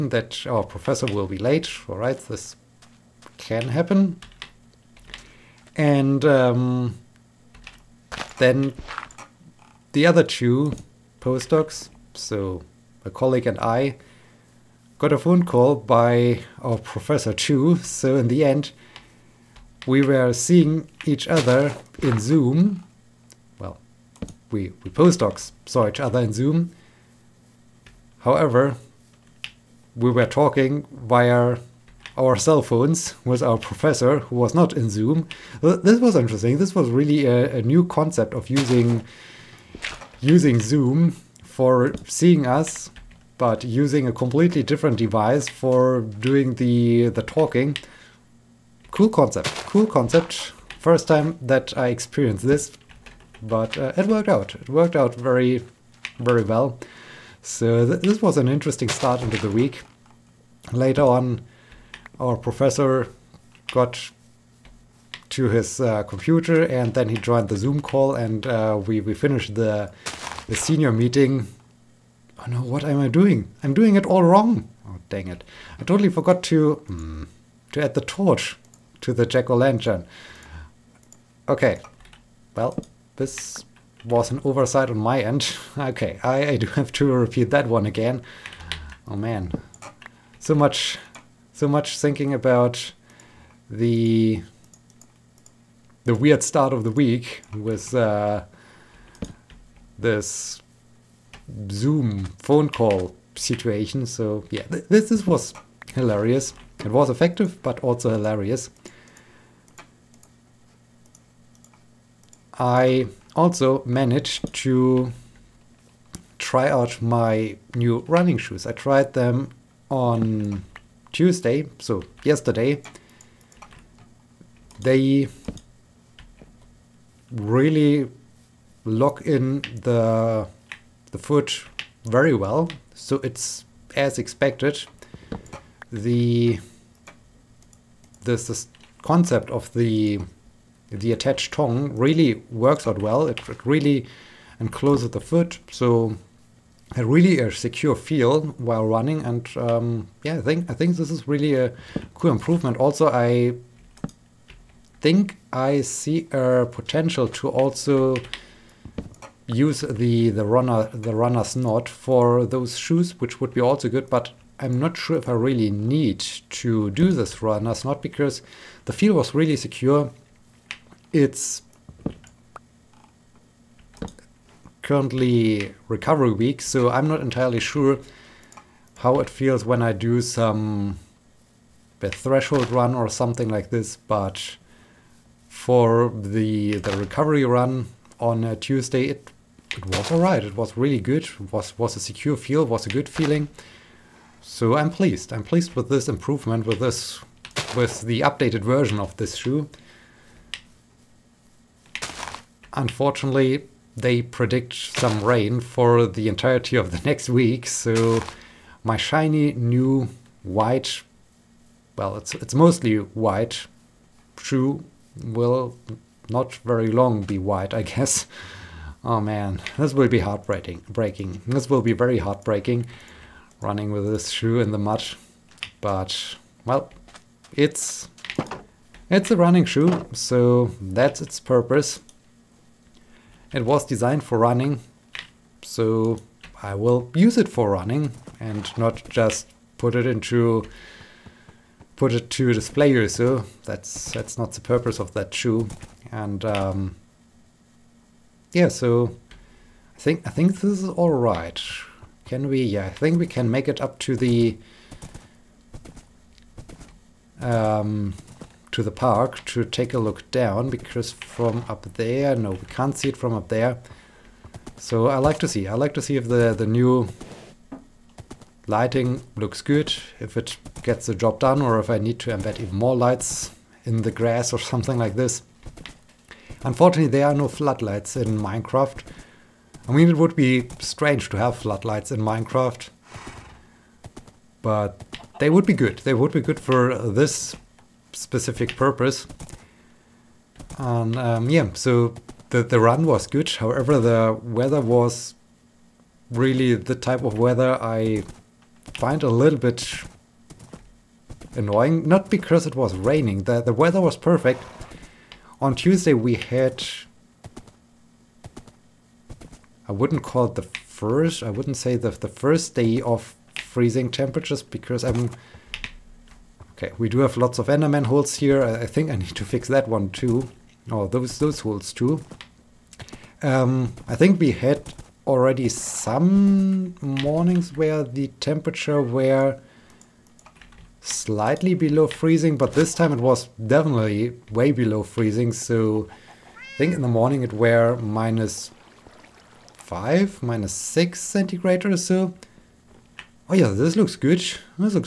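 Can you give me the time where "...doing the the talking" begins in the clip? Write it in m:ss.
0:46.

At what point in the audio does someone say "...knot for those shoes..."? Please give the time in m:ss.
2:41.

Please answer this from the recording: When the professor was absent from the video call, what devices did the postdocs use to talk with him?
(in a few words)
cell phones.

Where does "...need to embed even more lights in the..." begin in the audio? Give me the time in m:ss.
4:31.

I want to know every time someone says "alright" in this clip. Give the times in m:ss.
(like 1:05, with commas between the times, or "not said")
3:10.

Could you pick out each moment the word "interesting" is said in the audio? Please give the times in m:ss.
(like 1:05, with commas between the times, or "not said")
0:36, 0:58.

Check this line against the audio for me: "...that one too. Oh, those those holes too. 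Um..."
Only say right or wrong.
right.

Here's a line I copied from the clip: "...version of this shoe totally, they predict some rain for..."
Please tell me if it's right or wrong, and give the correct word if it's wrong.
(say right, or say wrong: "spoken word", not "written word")
wrong: "unfortunately", not "totally".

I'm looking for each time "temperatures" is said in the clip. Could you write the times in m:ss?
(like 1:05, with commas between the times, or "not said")
5:14, 5:28.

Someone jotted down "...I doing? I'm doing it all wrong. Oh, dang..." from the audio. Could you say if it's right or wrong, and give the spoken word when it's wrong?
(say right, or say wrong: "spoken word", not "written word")
right.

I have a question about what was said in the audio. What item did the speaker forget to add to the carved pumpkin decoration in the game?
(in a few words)
the torch.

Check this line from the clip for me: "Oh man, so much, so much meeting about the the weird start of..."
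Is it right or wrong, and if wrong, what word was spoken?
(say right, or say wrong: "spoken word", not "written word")
wrong: "thinking", not "meeting".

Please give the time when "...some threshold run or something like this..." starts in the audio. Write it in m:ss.
3:00.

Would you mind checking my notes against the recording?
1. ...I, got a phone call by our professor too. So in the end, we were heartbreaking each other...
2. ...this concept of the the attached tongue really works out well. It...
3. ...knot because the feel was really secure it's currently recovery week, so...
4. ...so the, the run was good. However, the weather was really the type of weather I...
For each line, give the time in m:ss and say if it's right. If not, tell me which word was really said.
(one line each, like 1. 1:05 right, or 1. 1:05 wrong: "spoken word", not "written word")
1. 0:13 wrong: "seeing", not "heartbreaking"
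2. 2:18 right
3. 2:47 right
4. 4:51 right.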